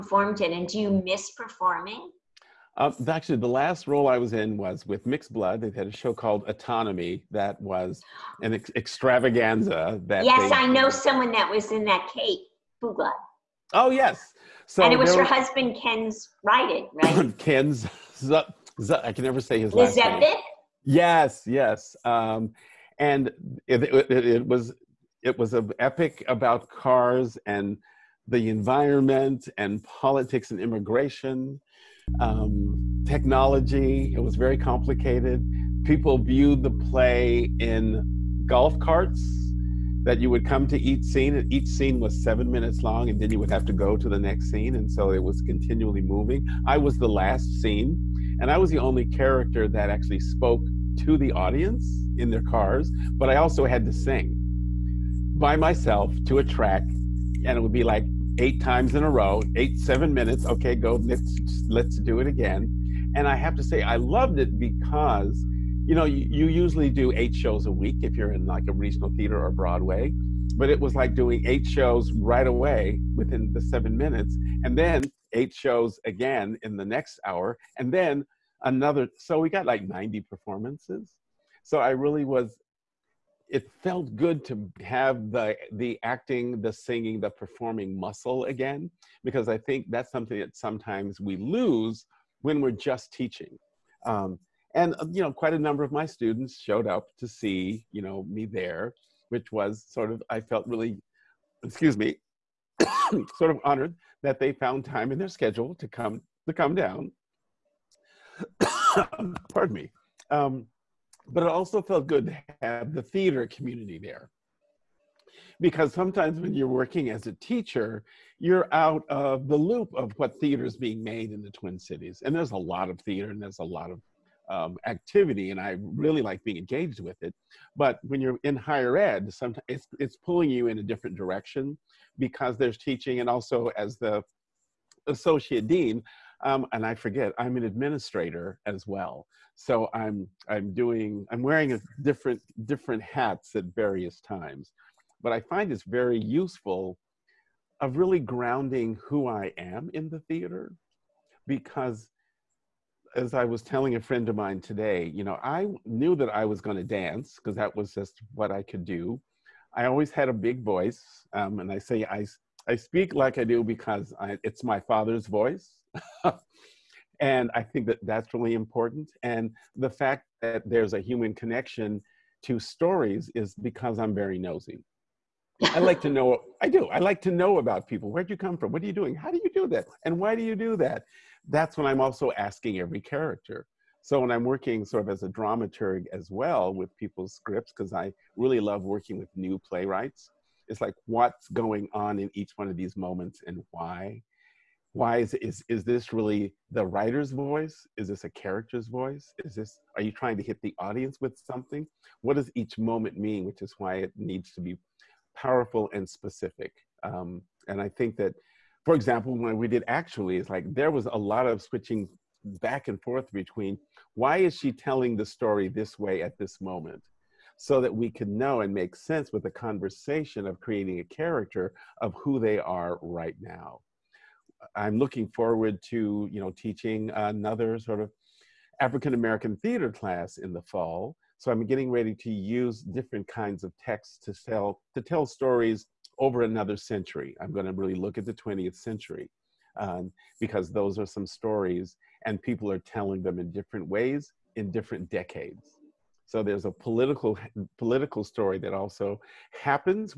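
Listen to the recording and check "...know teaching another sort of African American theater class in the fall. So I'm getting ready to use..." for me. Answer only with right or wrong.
right.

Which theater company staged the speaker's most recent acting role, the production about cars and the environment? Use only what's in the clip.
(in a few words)
Mixed Blood.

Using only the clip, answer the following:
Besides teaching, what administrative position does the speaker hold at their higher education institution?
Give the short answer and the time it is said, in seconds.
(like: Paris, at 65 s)
associate dean, at 135 s.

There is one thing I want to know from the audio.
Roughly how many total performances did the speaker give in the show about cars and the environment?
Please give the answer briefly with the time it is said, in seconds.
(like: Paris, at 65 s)
90, at 79 s.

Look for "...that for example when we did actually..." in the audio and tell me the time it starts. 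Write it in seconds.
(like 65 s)
208 s.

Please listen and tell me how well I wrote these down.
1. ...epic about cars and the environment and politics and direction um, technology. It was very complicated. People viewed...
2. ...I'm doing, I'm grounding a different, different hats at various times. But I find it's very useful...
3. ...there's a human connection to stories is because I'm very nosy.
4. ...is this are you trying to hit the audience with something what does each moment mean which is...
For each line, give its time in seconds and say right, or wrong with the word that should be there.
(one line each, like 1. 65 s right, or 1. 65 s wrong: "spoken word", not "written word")
1. 25 s wrong: "immigration", not "direction"
2. 140 s wrong: "wearing", not "grounding"
3. 170 s right
4. 199 s right.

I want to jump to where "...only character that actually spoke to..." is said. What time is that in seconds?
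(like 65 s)
48 s.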